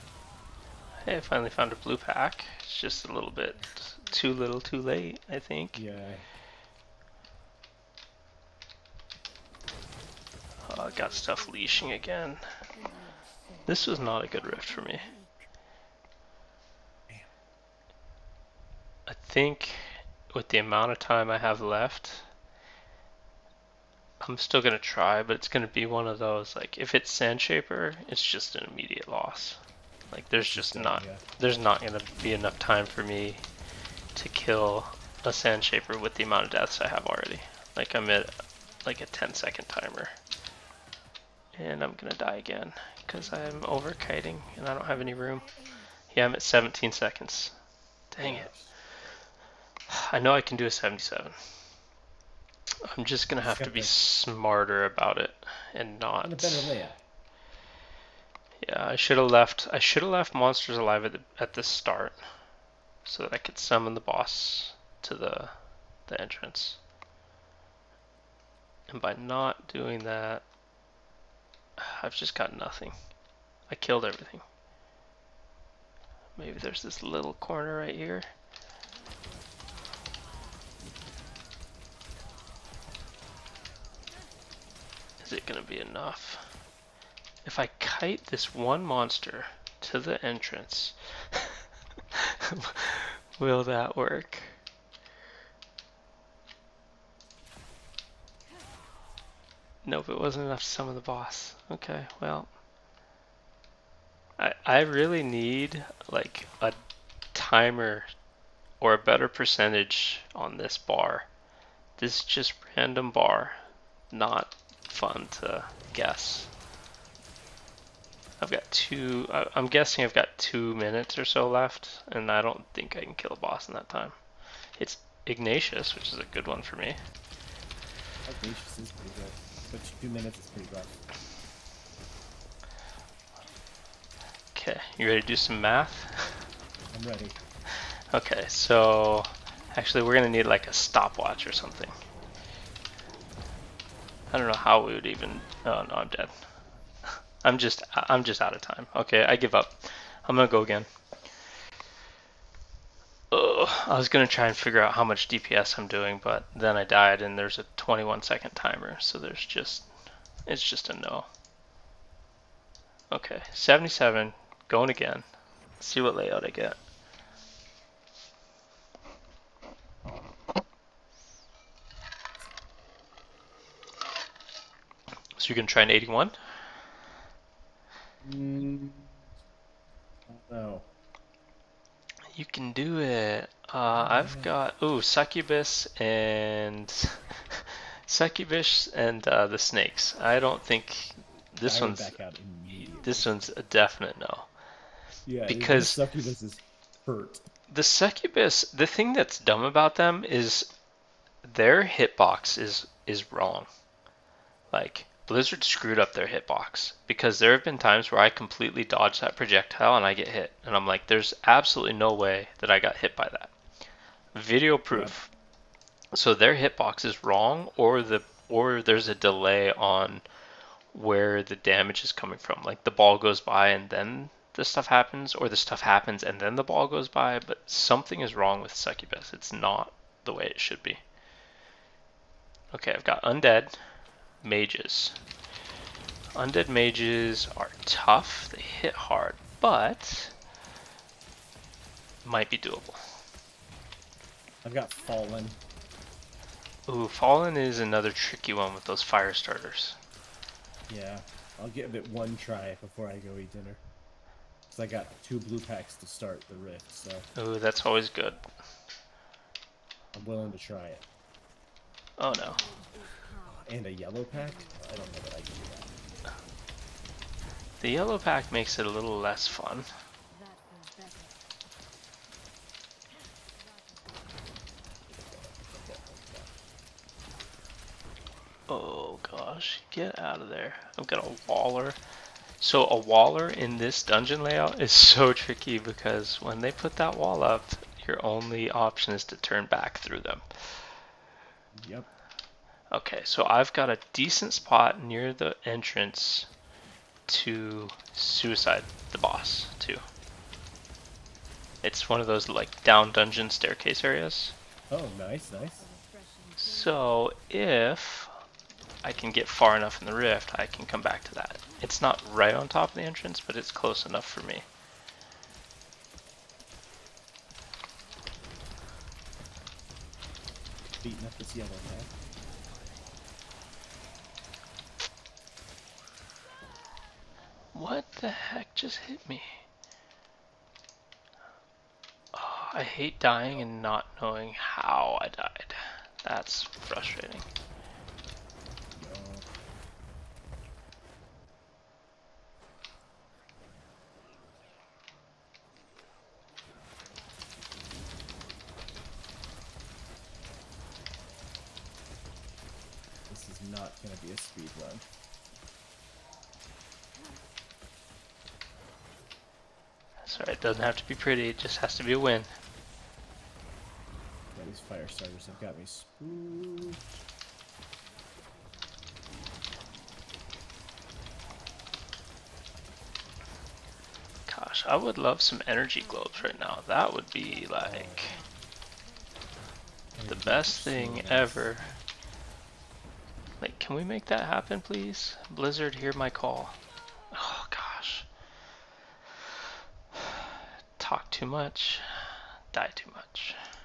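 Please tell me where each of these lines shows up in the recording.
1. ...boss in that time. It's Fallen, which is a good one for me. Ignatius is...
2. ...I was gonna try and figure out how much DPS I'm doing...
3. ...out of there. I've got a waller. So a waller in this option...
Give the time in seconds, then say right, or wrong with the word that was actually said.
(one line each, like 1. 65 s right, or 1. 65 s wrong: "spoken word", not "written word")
1. 123 s wrong: "Ignatius", not "Fallen"
2. 153 s right
3. 280 s wrong: "dungeon", not "option".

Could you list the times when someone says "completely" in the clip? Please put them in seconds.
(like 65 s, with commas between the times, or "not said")
208 s.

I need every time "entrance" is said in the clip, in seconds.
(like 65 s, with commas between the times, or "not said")
66 s, 90 s, 295 s, 313 s.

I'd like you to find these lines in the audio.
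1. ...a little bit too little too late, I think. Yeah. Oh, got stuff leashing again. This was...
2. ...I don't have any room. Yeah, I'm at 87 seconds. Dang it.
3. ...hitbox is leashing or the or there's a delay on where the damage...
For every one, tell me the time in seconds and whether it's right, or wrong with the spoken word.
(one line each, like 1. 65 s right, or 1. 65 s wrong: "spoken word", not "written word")
1. 3 s right
2. 44 s wrong: "17", not "87"
3. 216 s wrong: "wrong", not "leashing".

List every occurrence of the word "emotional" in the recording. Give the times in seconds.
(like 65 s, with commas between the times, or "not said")
not said.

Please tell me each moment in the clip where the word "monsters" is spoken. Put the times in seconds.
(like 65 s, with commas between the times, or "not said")
60 s, 88 s.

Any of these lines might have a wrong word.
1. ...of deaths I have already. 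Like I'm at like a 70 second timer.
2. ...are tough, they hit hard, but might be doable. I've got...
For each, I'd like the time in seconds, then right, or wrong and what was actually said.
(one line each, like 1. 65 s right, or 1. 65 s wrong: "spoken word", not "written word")
1. 36 s wrong: "10", not "70"
2. 237 s right.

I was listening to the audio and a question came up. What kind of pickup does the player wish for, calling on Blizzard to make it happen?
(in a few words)
energy globes.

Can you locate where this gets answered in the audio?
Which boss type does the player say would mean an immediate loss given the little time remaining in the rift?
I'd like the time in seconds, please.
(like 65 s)
27 s.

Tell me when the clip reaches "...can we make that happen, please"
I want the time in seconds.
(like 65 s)
383 s.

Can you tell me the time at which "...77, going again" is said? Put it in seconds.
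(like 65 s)
163 s.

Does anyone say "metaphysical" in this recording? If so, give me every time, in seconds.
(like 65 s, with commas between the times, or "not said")
not said.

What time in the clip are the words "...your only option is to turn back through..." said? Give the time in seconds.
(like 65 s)
288 s.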